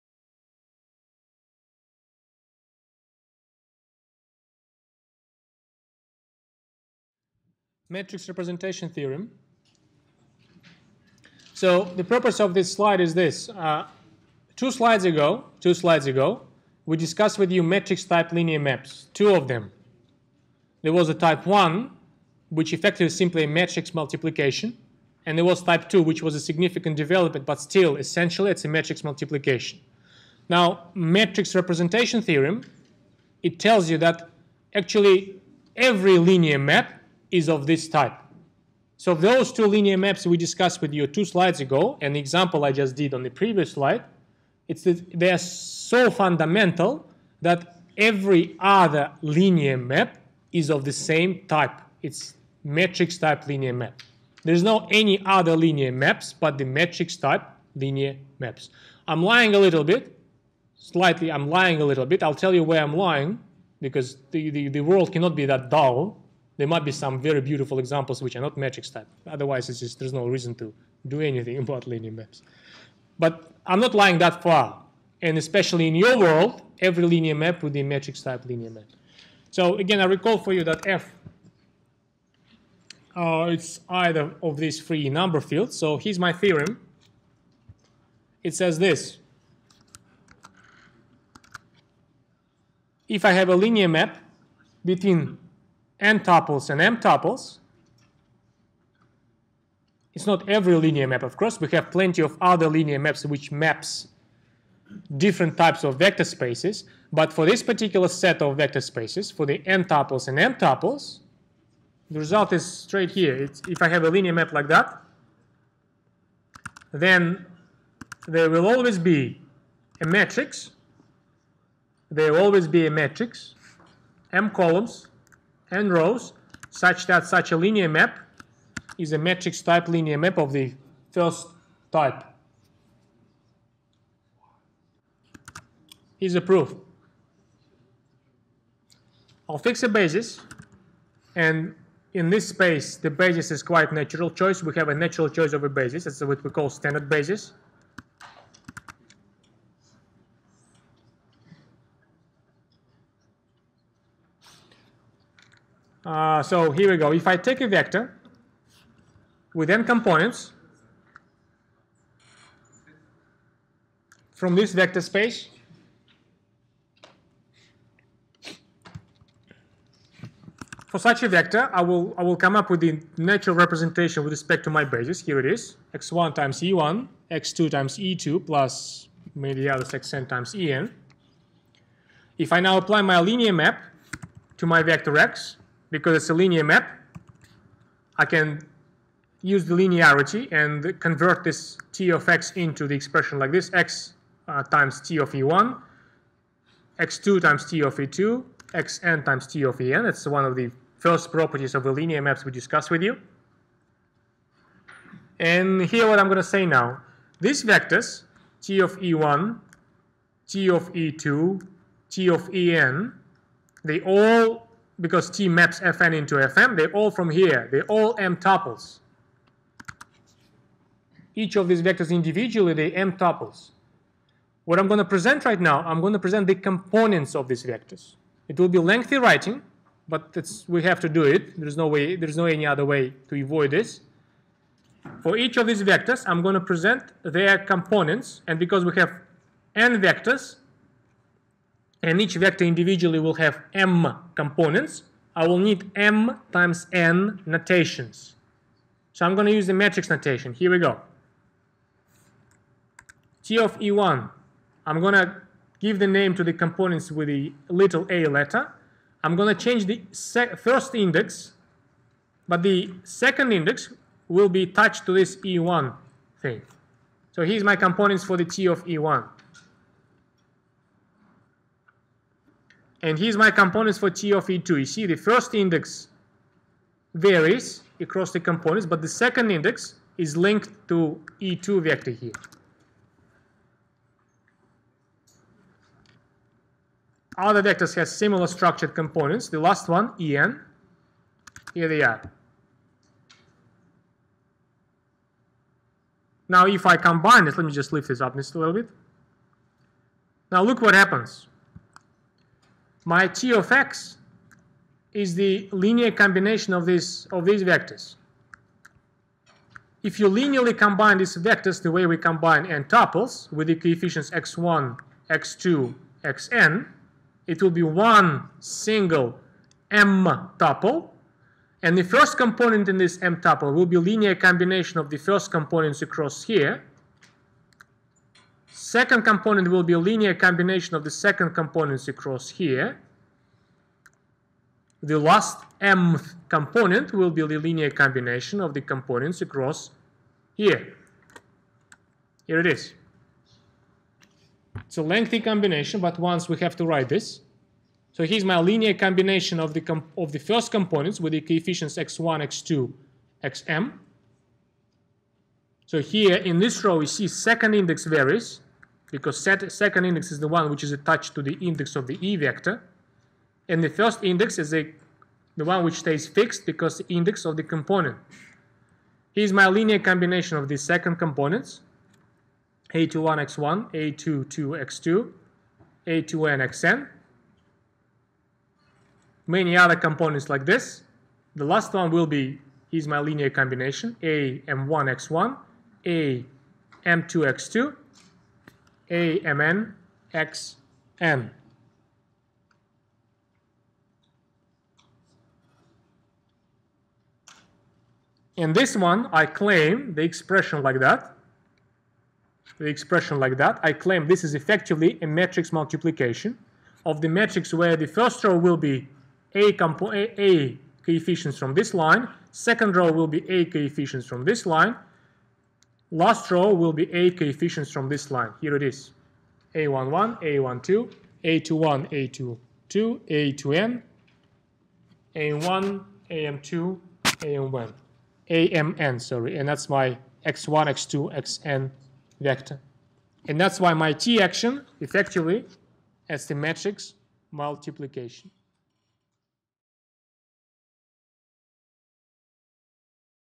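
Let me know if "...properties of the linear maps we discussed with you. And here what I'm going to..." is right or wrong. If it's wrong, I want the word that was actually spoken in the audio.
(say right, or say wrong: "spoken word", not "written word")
right.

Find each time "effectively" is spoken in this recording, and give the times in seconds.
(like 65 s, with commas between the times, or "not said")
22 s, 404 s, 434 s.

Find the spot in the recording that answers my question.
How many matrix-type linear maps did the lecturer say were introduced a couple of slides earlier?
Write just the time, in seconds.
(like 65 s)
19 s.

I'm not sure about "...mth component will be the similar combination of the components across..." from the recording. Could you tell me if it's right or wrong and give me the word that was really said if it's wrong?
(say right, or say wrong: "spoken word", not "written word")
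wrong: "linear", not "similar".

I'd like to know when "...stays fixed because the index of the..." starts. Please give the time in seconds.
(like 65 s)
365 s.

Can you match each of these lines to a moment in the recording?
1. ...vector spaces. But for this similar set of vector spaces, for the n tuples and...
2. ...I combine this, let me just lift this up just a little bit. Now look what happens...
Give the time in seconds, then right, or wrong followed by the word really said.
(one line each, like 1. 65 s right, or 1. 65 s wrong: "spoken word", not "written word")
1. 105 s wrong: "particular", not "similar"
2. 296 s right.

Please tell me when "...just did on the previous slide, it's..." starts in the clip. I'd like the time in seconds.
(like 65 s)
42 s.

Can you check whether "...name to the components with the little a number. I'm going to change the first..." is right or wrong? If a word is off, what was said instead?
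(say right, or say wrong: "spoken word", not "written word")
wrong: "letter", not "number".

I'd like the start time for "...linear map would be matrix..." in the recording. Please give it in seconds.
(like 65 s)
77 s.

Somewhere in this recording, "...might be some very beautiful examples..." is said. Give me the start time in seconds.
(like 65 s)
66 s.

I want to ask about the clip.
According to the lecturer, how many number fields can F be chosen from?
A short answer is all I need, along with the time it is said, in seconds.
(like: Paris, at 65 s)
3, at 84 s.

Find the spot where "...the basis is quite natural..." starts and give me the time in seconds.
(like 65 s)
142 s.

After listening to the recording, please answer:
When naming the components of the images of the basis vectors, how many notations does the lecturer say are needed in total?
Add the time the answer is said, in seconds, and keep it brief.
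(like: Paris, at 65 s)
m times n, at 245 s.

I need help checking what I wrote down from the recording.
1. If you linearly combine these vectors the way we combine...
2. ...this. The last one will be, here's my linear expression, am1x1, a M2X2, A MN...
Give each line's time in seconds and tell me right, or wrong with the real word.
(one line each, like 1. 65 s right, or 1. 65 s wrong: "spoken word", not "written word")
1. 310 s right
2. 380 s wrong: "combination", not "expression".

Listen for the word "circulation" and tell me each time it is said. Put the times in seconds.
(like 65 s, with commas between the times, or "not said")
not said.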